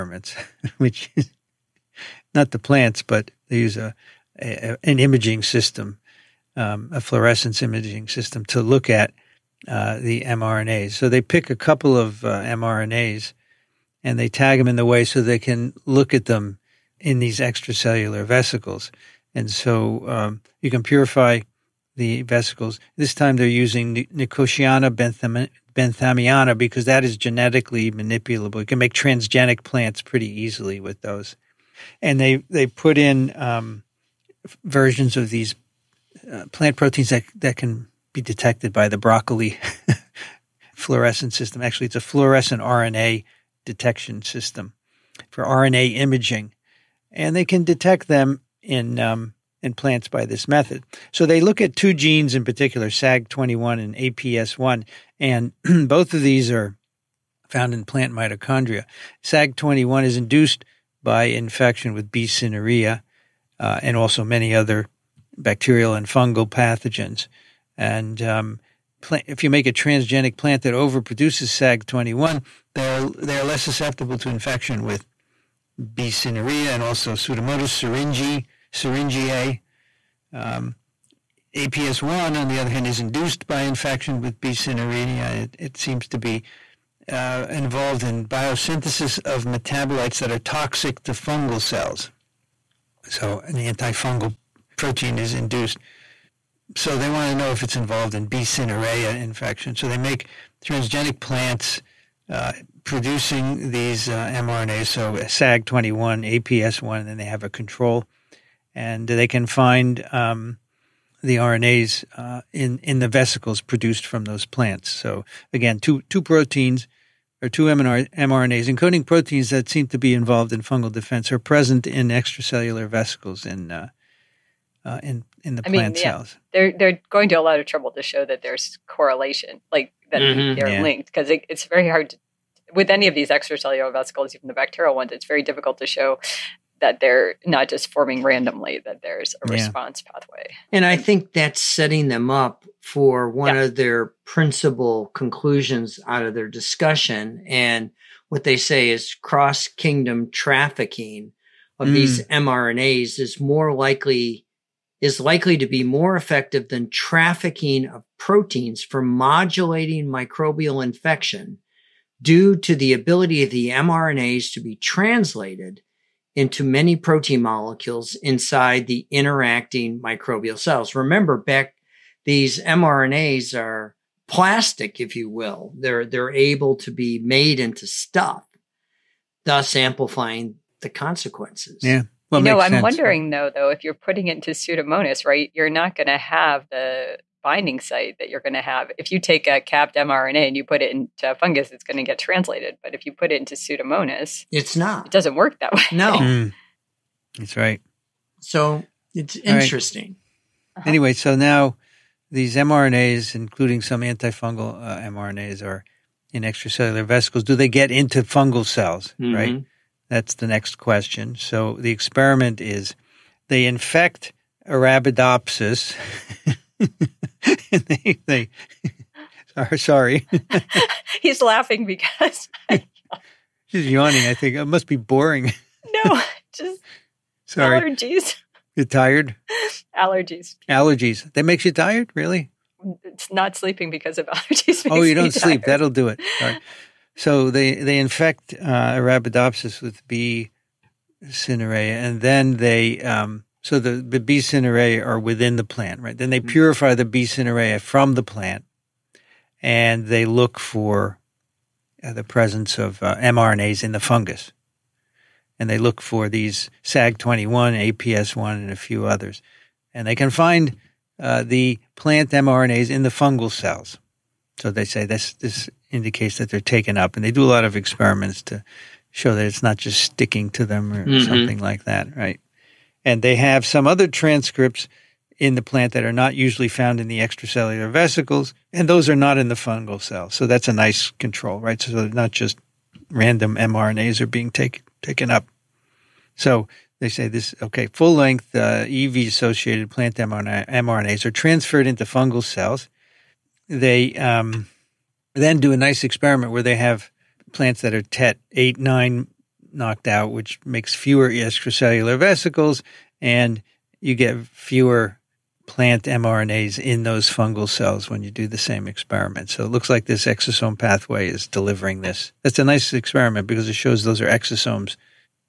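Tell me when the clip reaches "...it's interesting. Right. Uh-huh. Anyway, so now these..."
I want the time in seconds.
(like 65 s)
199 s.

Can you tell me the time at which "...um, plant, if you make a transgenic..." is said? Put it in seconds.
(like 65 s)
68 s.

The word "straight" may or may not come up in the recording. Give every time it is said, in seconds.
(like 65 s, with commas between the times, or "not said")
not said.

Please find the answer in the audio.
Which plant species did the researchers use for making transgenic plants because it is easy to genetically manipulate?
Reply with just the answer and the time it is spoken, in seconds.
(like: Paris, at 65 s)
Nicotiana benthamiana, at 24 s.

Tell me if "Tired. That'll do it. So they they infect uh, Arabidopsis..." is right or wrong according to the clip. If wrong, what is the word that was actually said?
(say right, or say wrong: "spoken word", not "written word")
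right.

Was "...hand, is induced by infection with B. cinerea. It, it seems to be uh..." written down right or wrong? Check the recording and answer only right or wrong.
right.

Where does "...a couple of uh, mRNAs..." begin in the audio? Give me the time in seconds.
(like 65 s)
11 s.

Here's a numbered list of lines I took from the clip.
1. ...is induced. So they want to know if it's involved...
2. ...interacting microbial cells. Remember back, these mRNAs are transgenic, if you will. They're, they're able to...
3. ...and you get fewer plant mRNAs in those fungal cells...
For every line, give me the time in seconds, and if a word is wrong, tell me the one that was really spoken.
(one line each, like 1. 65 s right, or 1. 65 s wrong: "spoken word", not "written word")
1. 95 s right
2. 169 s wrong: "plastic", not "transgenic"
3. 303 s right.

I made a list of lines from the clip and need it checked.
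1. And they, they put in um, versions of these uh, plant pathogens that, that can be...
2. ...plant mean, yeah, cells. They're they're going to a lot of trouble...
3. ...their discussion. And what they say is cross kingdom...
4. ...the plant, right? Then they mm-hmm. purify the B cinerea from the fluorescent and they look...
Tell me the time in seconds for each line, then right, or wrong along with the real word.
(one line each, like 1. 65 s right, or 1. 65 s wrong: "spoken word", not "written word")
1. 32 s wrong: "proteins", not "pathogens"
2. 125 s right
3. 146 s right
4. 245 s wrong: "plant", not "fluorescent".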